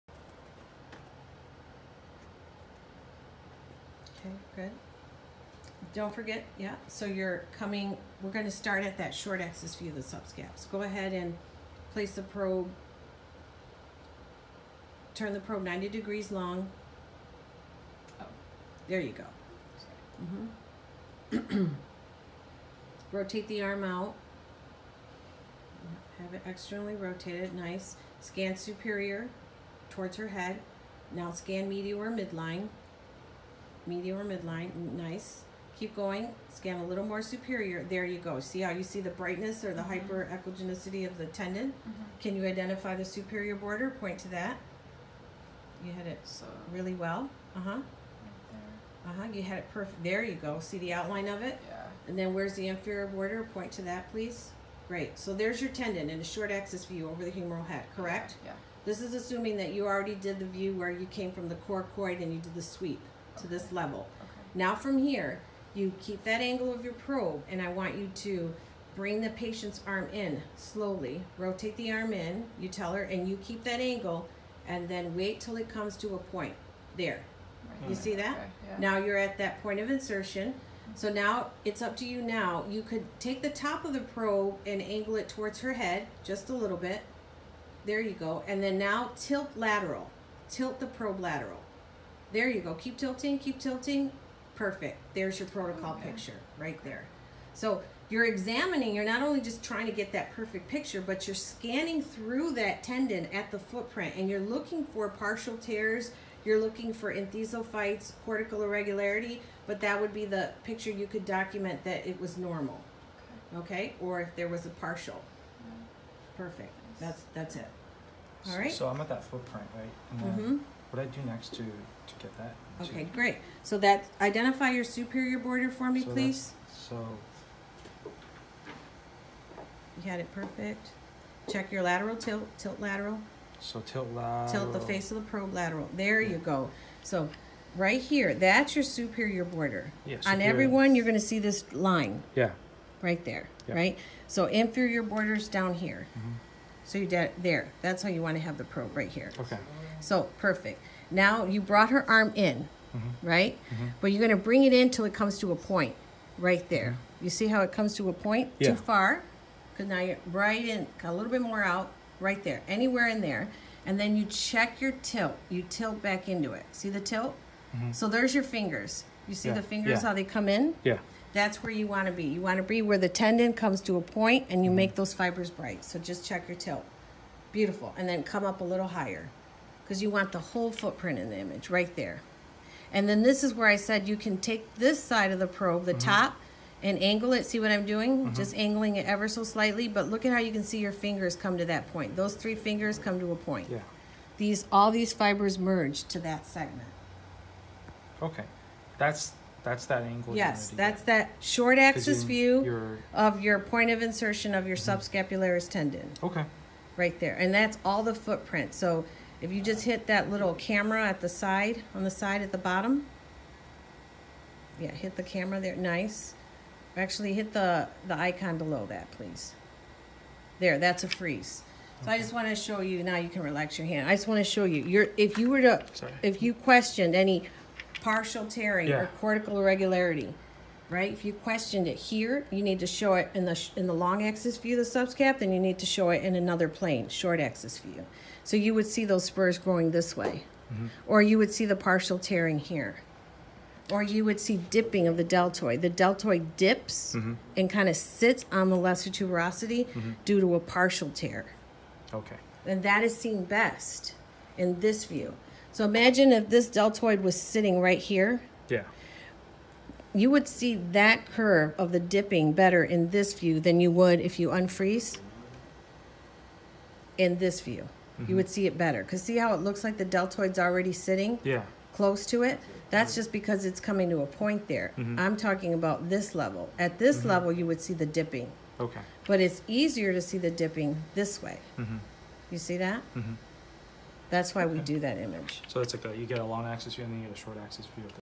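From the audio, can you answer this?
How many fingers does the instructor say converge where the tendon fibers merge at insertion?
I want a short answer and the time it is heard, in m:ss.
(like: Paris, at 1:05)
3, at 3:12.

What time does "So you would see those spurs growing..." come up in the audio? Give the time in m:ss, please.
3:58.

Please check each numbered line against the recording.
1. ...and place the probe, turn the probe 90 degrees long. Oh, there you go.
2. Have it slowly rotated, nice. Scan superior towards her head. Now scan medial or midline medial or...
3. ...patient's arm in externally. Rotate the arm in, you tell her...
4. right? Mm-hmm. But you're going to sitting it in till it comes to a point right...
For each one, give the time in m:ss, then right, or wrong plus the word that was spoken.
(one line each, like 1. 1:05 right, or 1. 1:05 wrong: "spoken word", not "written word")
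1. 0:11 right
2. 0:26 wrong: "externally", not "slowly"
3. 1:09 wrong: "slowly", not "externally"
4. 2:33 wrong: "bring", not "sitting".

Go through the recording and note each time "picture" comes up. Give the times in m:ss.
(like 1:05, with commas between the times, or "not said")
1:36, 1:40, 1:50.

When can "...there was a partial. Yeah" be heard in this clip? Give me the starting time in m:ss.
1:54.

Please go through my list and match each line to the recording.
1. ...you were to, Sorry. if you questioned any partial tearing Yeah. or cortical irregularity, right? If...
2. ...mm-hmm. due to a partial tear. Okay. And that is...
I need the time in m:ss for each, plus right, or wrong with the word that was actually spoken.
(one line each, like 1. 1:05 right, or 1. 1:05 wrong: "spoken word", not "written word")
1. 3:45 right
2. 4:09 right.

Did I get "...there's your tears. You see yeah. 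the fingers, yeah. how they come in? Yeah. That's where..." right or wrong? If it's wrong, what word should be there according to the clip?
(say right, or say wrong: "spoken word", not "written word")
wrong: "fingers", not "tears".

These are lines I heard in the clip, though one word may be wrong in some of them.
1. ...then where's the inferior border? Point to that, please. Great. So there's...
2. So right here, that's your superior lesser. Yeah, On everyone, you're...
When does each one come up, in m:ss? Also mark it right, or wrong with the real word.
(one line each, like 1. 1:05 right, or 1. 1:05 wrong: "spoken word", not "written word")
1. 0:52 right
2. 2:17 wrong: "border", not "lesser".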